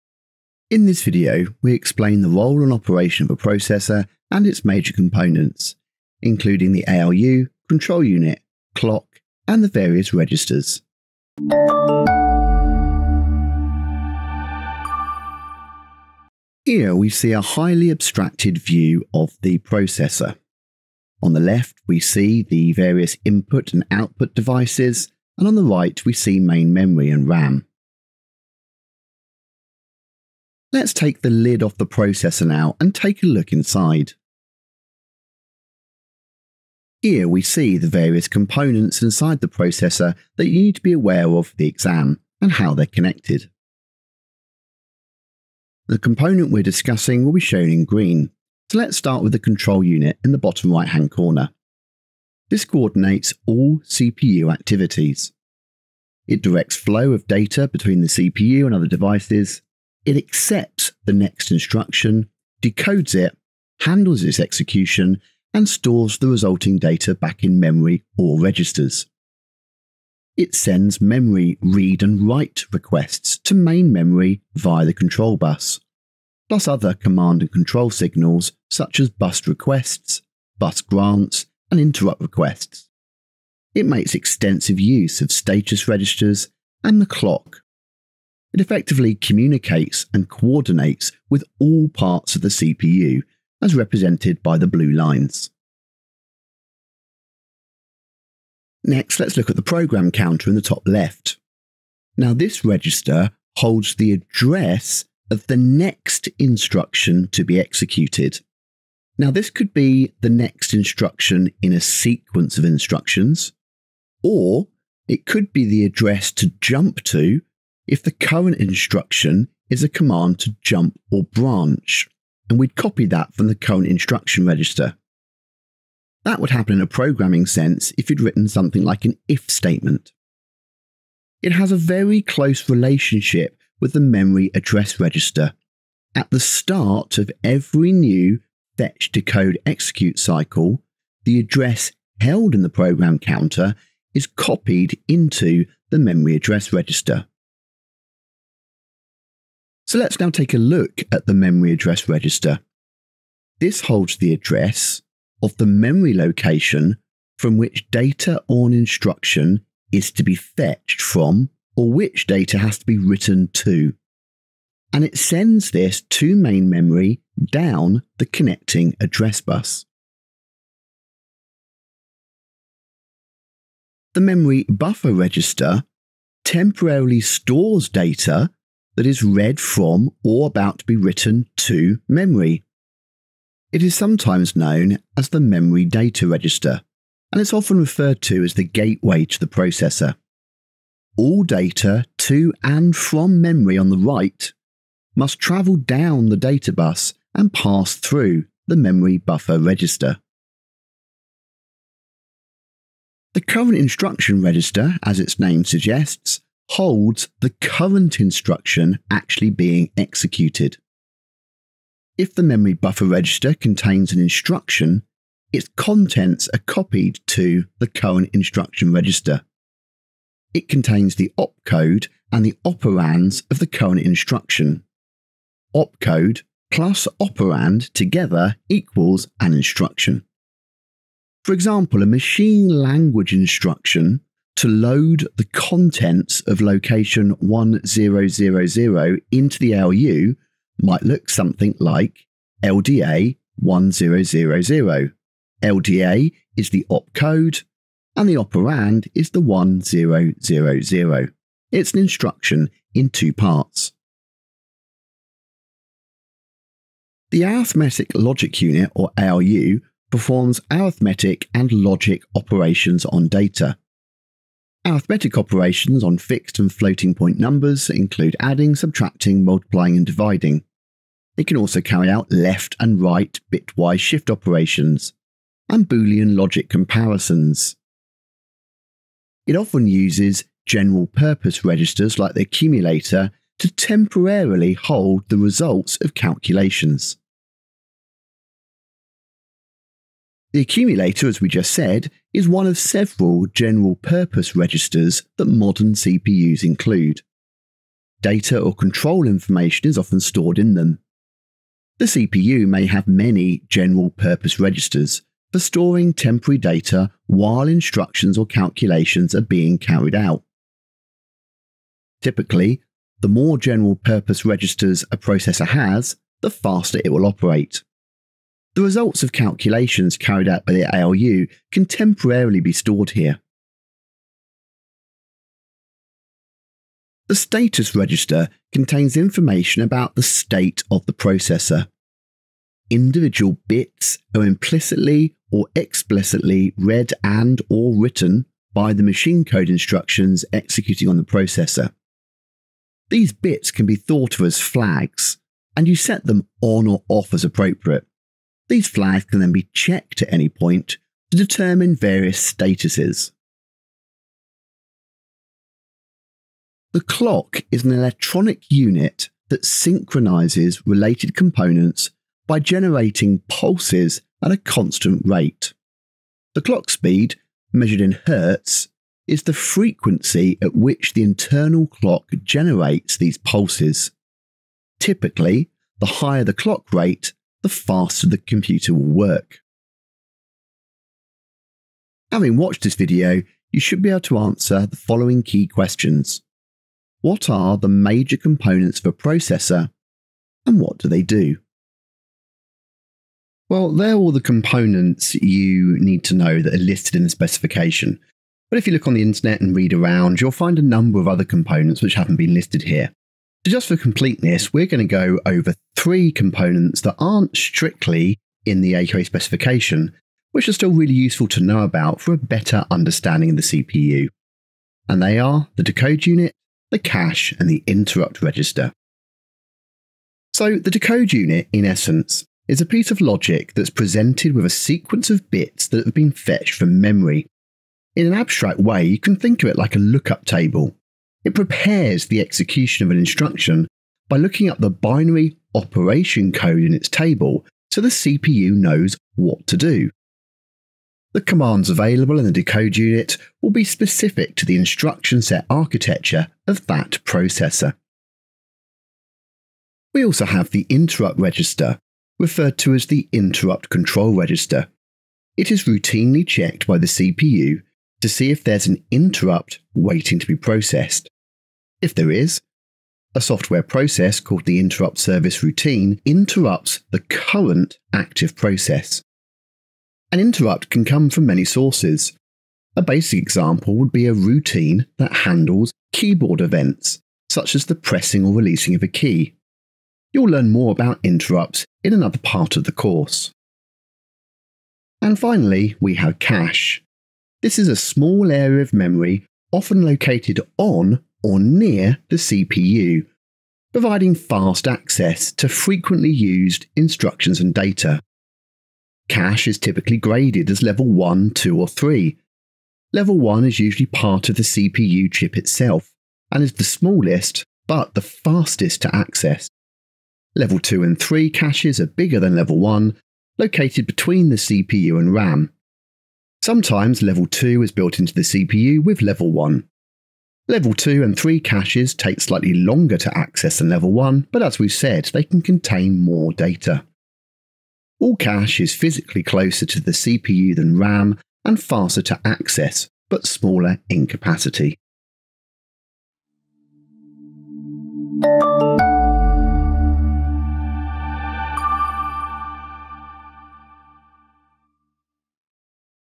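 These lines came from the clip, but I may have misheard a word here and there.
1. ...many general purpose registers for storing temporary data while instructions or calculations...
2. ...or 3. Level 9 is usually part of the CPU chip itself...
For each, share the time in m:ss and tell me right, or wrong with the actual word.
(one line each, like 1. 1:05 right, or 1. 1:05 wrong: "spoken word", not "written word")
1. 5:03 right
2. 8:21 wrong: "1", not "9".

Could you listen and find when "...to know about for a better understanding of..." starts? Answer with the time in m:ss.
6:51.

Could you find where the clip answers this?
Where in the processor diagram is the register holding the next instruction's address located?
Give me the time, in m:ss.
1:40.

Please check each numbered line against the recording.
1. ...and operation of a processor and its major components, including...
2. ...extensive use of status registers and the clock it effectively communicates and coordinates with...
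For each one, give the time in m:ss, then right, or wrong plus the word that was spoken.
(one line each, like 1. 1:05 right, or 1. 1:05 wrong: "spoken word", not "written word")
1. 0:02 right
2. 1:24 right.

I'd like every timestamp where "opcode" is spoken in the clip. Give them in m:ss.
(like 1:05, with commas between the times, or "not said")
3:41, 3:45, 4:06.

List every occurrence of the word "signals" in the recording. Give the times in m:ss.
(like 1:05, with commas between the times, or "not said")
1:17.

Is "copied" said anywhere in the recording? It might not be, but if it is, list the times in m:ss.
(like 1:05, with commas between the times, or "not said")
2:24, 3:36.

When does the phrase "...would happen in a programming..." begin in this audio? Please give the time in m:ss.
2:06.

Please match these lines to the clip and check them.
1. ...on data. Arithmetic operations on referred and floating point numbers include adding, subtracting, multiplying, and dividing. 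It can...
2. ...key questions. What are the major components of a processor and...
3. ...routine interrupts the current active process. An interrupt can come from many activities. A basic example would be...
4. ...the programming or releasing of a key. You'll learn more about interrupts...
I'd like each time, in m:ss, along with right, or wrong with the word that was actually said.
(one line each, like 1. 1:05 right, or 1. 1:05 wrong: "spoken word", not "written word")
1. 4:23 wrong: "fixed", not "referred"
2. 6:25 right
3. 7:45 wrong: "sources", not "activities"
4. 7:57 wrong: "pressing", not "programming".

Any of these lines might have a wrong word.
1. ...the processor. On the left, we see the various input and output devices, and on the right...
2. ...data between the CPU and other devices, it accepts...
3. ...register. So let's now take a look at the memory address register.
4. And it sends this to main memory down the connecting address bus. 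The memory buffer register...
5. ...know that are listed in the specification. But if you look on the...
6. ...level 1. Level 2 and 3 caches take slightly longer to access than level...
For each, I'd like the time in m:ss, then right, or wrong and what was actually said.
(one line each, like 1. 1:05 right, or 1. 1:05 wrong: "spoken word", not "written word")
1. 0:19 right
2. 0:57 right
3. 2:26 right
4. 2:44 right
5. 6:36 right
6. 8:39 right.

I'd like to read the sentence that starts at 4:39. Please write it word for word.
It often uses general purpose registers like the accumulator to temporarily hold the results of calculations.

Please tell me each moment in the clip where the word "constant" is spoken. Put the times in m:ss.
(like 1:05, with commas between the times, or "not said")
6:04.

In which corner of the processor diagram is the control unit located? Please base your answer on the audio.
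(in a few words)
bottom right hand corner.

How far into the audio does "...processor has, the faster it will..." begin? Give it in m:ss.
5:15.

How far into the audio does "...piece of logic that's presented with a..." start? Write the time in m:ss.
7:02.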